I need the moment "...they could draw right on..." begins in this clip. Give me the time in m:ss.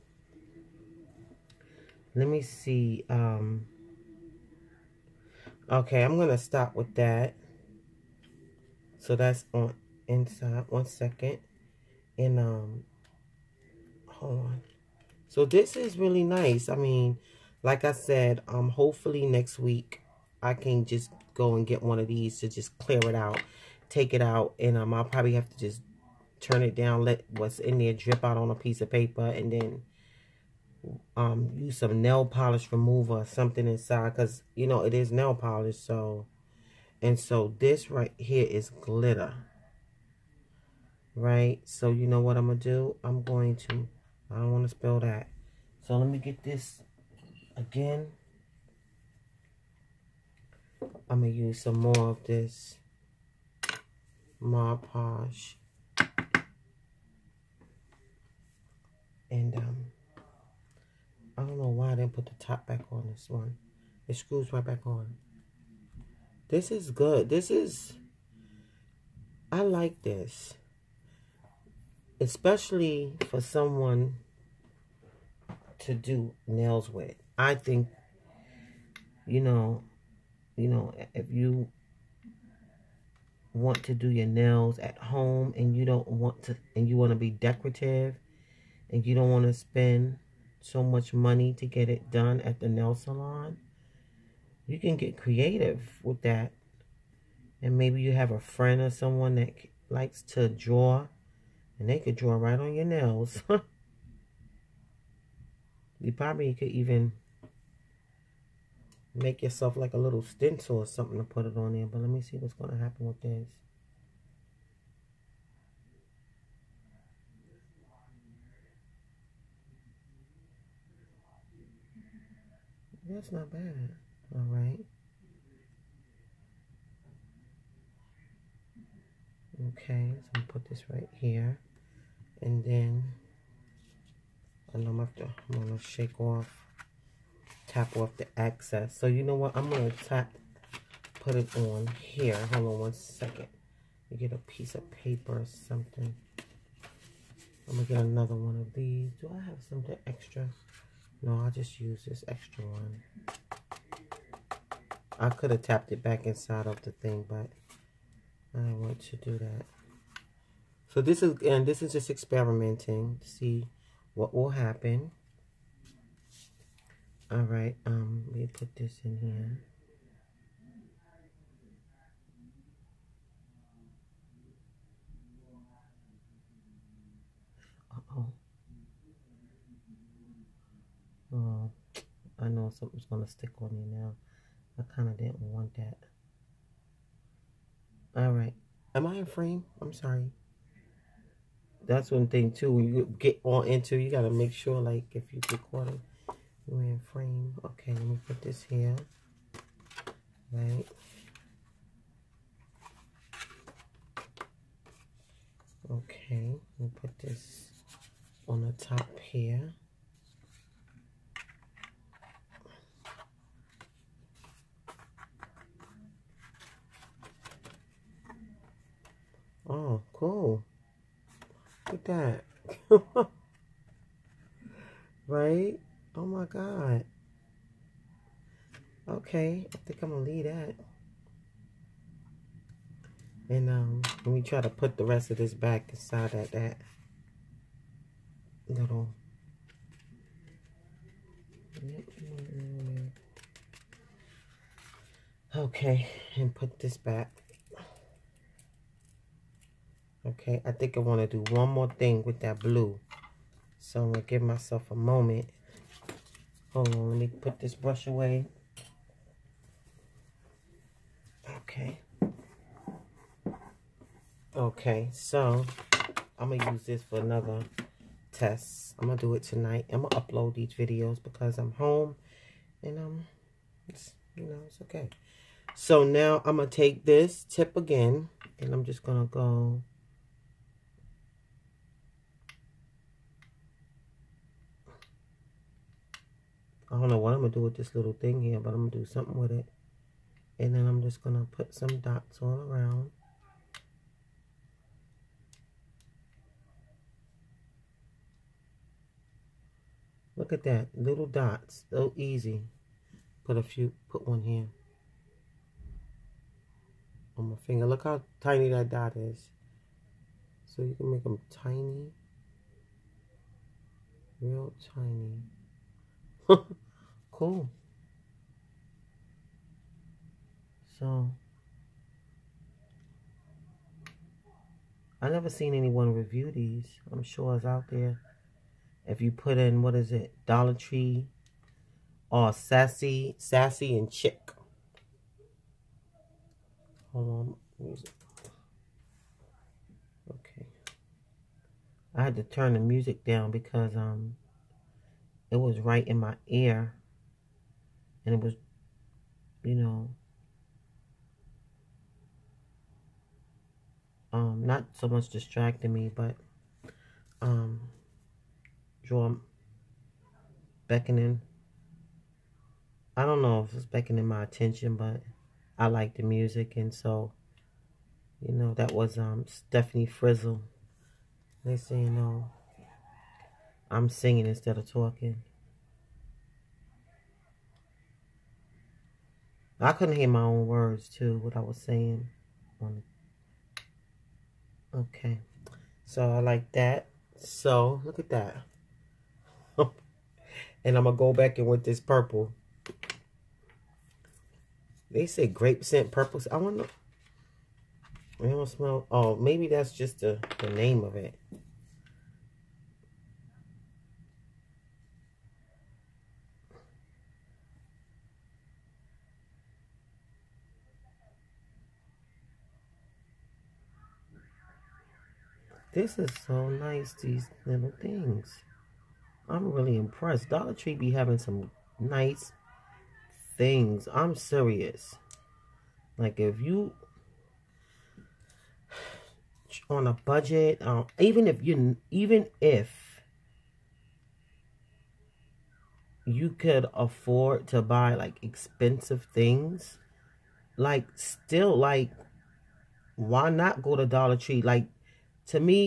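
1:41.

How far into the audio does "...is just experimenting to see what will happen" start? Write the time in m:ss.
2:41.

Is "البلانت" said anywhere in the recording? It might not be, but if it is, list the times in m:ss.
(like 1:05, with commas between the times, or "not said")
not said.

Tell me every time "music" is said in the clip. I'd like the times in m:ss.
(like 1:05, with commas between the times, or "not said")
5:37, 5:42, 6:06.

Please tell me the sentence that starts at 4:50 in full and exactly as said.
And then I'm just going to put some dots all around.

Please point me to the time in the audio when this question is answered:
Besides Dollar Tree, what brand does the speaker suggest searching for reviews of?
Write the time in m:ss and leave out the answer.
5:33.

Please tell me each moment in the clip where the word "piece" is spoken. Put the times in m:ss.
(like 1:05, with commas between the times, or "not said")
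0:28, 2:24.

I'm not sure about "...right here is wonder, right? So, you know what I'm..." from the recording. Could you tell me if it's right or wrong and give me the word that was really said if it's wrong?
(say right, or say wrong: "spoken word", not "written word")
wrong: "glitter", not "wonder".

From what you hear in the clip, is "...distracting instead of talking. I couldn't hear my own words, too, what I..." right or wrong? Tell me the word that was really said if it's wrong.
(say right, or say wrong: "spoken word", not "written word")
wrong: "singing", not "distracting".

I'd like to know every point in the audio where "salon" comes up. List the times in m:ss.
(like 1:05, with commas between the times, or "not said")
1:32.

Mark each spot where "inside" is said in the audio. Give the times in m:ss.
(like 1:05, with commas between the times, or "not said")
0:10, 0:33, 2:36, 3:55.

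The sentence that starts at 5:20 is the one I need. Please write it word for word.
So, I never seen anyone review these.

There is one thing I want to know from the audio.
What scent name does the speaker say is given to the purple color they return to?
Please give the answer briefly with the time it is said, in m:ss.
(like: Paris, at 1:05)
grape, at 6:35.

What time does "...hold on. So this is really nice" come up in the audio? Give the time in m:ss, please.
0:14.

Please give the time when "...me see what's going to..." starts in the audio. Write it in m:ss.
1:52.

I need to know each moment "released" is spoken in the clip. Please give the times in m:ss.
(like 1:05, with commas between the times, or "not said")
not said.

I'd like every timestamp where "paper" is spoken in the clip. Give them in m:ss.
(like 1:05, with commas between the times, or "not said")
0:28, 2:24.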